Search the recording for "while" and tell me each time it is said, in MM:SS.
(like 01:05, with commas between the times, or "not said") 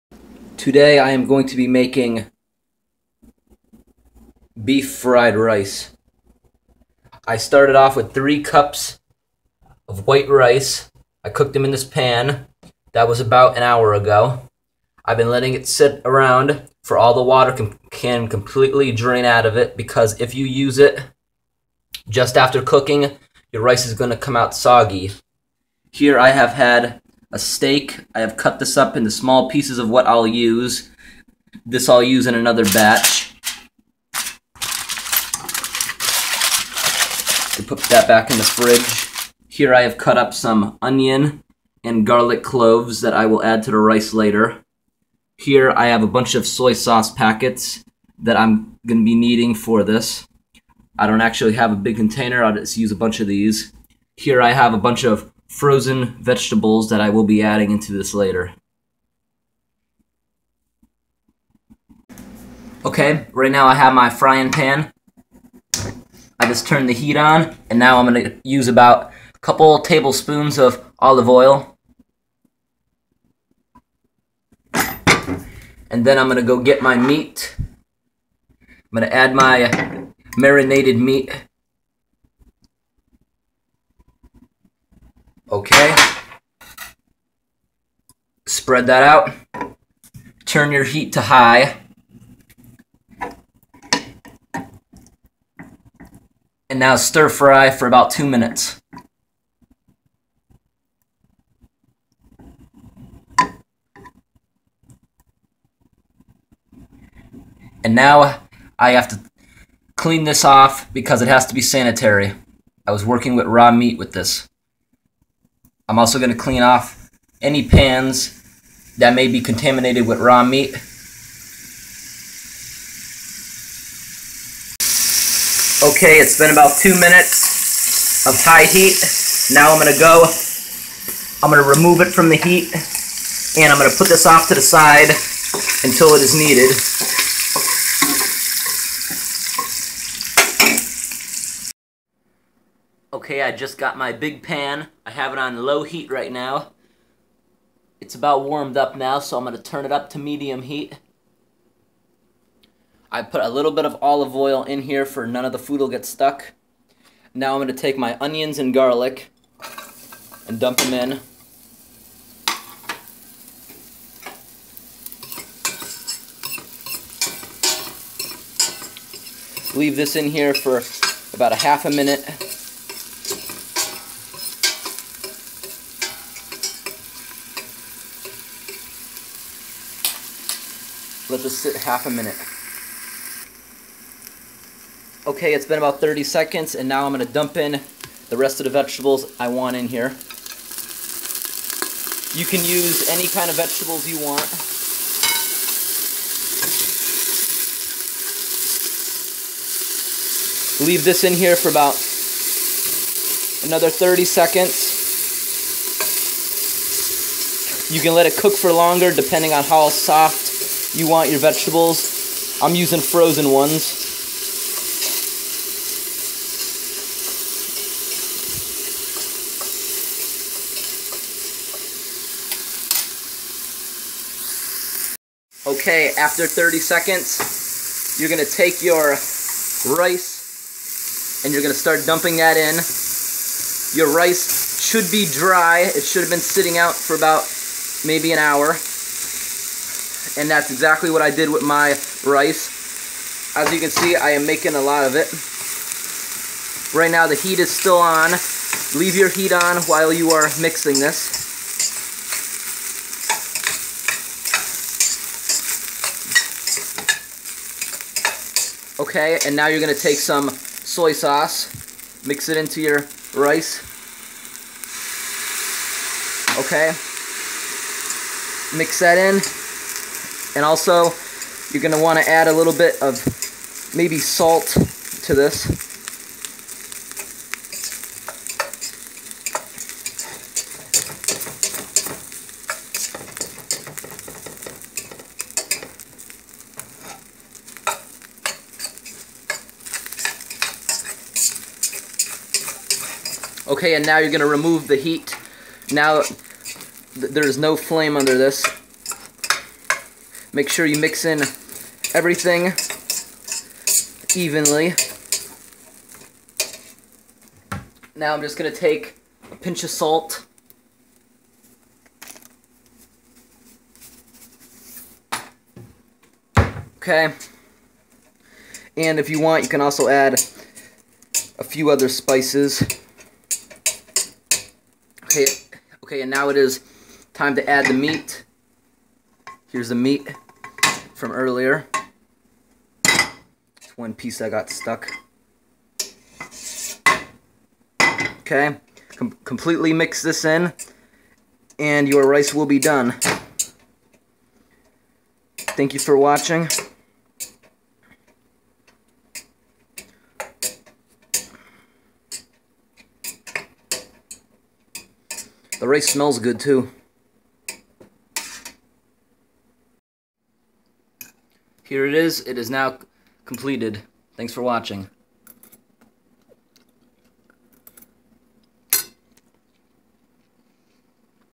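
04:09.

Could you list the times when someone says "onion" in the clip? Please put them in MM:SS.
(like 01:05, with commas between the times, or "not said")
00:40, 02:38.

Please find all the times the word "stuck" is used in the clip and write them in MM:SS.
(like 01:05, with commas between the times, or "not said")
02:36, 05:34.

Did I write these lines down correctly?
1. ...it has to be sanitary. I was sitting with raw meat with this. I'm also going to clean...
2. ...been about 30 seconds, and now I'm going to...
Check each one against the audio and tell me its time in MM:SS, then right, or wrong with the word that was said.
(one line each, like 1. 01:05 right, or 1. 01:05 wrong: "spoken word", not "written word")
1. 01:51 wrong: "working", not "sitting"
2. 03:05 right.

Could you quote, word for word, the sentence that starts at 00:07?
I started off with three cups of white rice.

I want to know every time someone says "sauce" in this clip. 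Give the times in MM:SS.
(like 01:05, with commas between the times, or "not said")
00:46, 04:21.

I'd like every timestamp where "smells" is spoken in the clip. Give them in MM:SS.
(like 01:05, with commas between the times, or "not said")
05:56.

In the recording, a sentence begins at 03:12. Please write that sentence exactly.
You can use any kind of vegetables you want.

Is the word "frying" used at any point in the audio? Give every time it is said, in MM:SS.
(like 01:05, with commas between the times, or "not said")
01:04.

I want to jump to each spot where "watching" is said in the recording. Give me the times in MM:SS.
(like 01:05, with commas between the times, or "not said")
05:46, 06:04.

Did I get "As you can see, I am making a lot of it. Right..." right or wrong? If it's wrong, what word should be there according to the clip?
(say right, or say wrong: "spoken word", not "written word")
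right.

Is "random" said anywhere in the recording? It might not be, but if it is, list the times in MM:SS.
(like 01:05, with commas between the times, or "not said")
not said.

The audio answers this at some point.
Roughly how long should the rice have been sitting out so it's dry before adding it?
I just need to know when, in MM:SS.
03:57.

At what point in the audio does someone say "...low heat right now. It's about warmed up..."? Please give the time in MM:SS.
02:25.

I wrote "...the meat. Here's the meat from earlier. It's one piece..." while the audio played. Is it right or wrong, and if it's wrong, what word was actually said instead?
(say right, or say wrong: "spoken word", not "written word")
right.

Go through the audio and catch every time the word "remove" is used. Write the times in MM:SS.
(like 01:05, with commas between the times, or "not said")
02:11, 04:54.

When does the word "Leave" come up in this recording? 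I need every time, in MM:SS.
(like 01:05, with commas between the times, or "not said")
02:49, 03:20, 04:08.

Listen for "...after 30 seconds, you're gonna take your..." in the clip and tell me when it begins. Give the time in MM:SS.
03:46.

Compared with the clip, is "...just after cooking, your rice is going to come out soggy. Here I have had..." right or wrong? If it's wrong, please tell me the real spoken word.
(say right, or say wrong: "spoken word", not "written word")
right.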